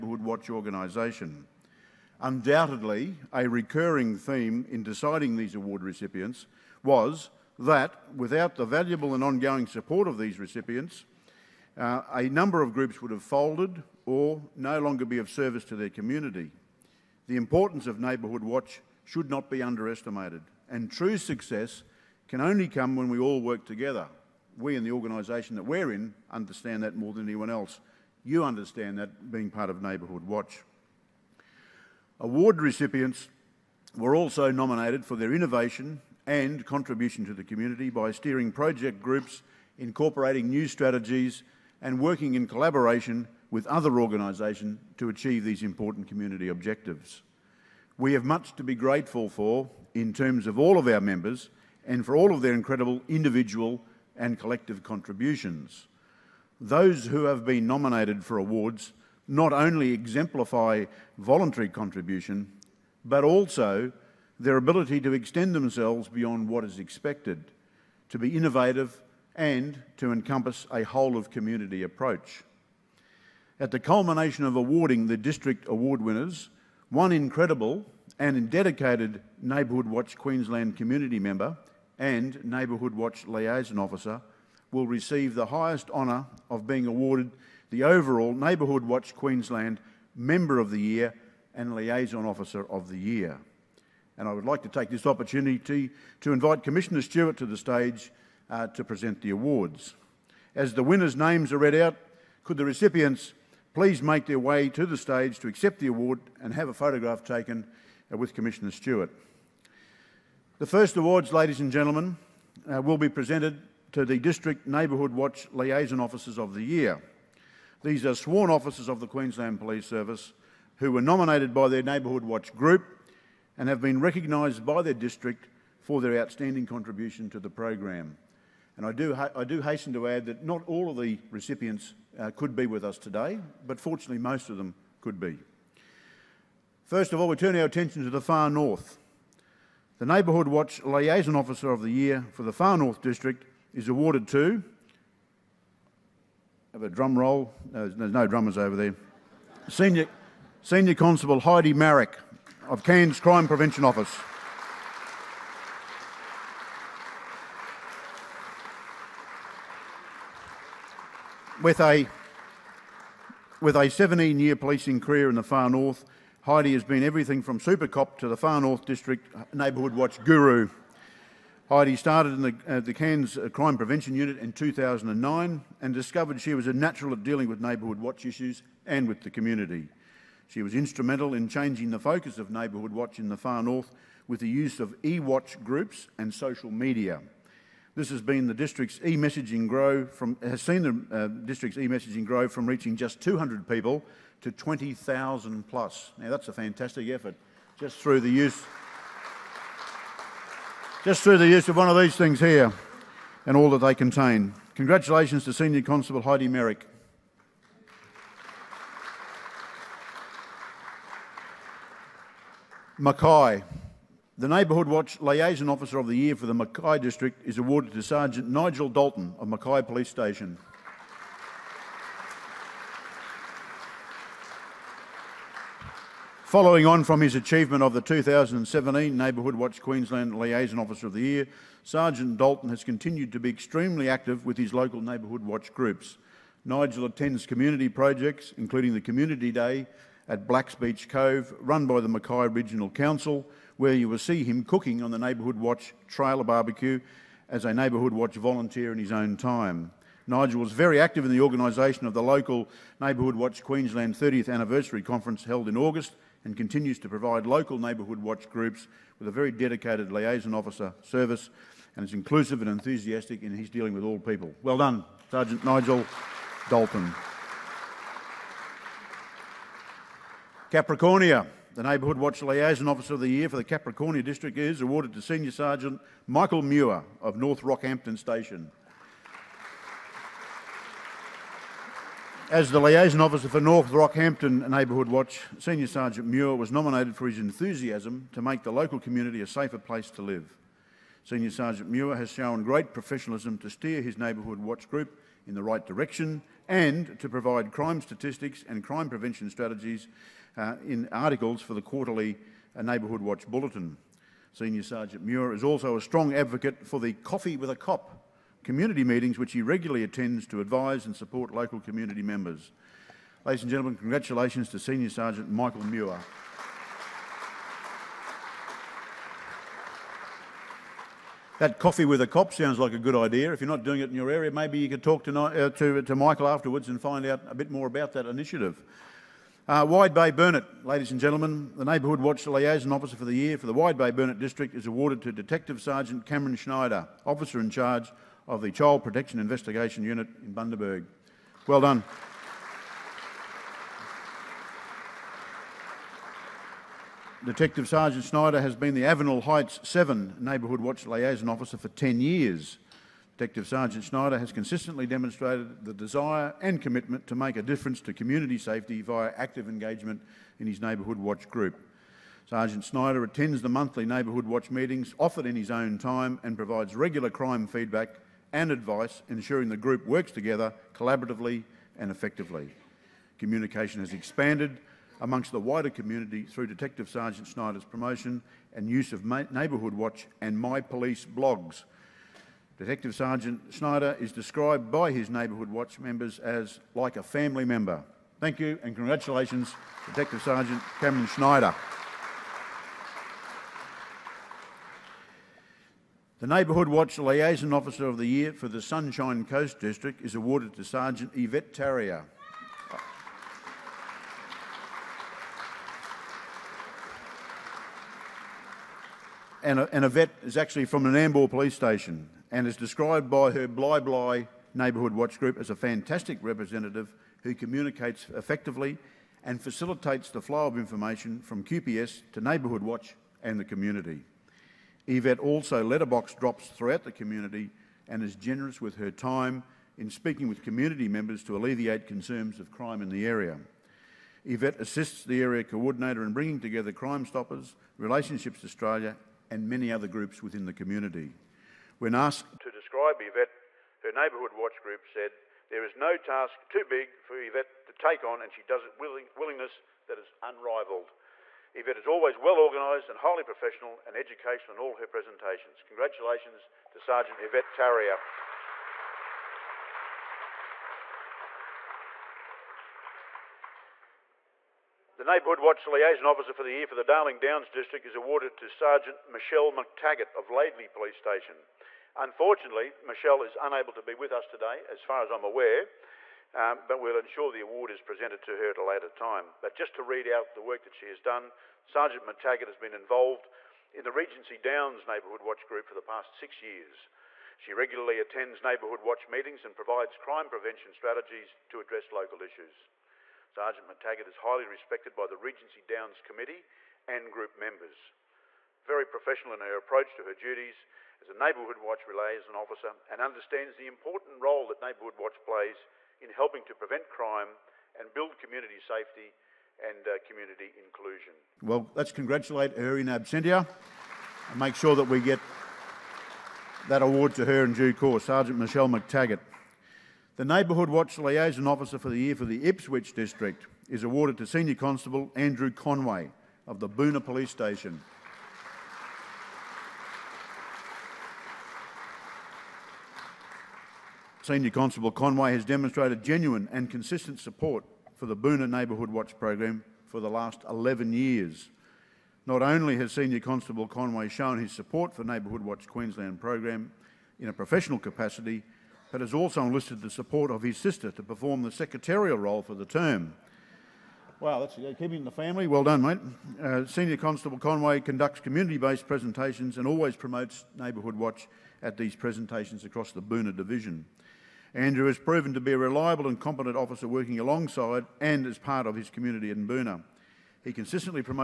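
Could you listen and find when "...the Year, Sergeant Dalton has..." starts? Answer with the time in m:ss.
3:51.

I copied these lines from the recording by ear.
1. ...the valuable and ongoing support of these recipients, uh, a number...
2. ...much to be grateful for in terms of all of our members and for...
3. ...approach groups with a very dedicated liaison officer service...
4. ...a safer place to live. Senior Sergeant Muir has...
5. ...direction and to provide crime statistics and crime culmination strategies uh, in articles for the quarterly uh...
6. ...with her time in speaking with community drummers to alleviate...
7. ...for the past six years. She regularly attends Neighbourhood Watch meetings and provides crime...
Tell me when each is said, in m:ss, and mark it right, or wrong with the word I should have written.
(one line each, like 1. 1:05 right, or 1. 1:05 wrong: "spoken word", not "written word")
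1. 0:08 right
2. 0:48 right
3. 4:18 wrong: "watch", not "approach"
4. 4:49 right
5. 4:55 wrong: "prevention", not "culmination"
6. 7:08 wrong: "members", not "drummers"
7. 8:05 right.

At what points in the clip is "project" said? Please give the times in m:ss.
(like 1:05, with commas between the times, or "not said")
0:38, 3:57.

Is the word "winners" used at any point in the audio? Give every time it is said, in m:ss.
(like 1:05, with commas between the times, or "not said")
1:16, 1:40.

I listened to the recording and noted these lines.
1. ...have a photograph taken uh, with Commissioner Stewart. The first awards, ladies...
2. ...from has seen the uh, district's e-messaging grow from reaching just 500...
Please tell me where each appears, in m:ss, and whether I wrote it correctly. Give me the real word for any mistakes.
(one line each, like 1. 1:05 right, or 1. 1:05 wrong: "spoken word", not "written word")
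1. 1:46 right
2. 3:10 wrong: "200", not "500".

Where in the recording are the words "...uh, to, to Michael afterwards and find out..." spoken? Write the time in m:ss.
5:25.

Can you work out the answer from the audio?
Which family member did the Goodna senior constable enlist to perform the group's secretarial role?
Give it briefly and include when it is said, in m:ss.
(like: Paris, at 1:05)
His sister, at 9:10.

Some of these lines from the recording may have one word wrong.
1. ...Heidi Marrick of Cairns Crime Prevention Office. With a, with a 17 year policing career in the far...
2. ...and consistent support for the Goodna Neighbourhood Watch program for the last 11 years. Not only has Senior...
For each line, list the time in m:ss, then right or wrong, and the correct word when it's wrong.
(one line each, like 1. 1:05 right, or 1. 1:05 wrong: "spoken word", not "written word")
1. 2:31 right
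2. 8:56 right.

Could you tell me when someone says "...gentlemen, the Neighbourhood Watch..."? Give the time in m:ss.
5:31.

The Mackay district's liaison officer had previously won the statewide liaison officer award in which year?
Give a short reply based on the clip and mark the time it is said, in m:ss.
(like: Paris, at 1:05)
2017, at 3:48.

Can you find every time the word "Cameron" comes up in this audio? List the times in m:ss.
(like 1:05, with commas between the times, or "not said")
5:36, 6:31.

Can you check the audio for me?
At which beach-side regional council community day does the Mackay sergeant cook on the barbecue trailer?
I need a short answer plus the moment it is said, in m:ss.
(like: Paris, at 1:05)
Blacks Beach Cove, at 4:00.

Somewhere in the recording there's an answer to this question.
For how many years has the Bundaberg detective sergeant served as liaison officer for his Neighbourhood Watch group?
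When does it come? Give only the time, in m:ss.
5:51.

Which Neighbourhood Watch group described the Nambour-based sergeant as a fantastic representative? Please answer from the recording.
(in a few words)
Bli Bli.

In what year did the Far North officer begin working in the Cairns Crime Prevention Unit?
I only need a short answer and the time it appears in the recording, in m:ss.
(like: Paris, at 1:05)
2009, at 2:54.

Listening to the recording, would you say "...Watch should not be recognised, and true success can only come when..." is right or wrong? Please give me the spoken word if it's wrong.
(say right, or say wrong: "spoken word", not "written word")
wrong: "underestimated", not "recognised".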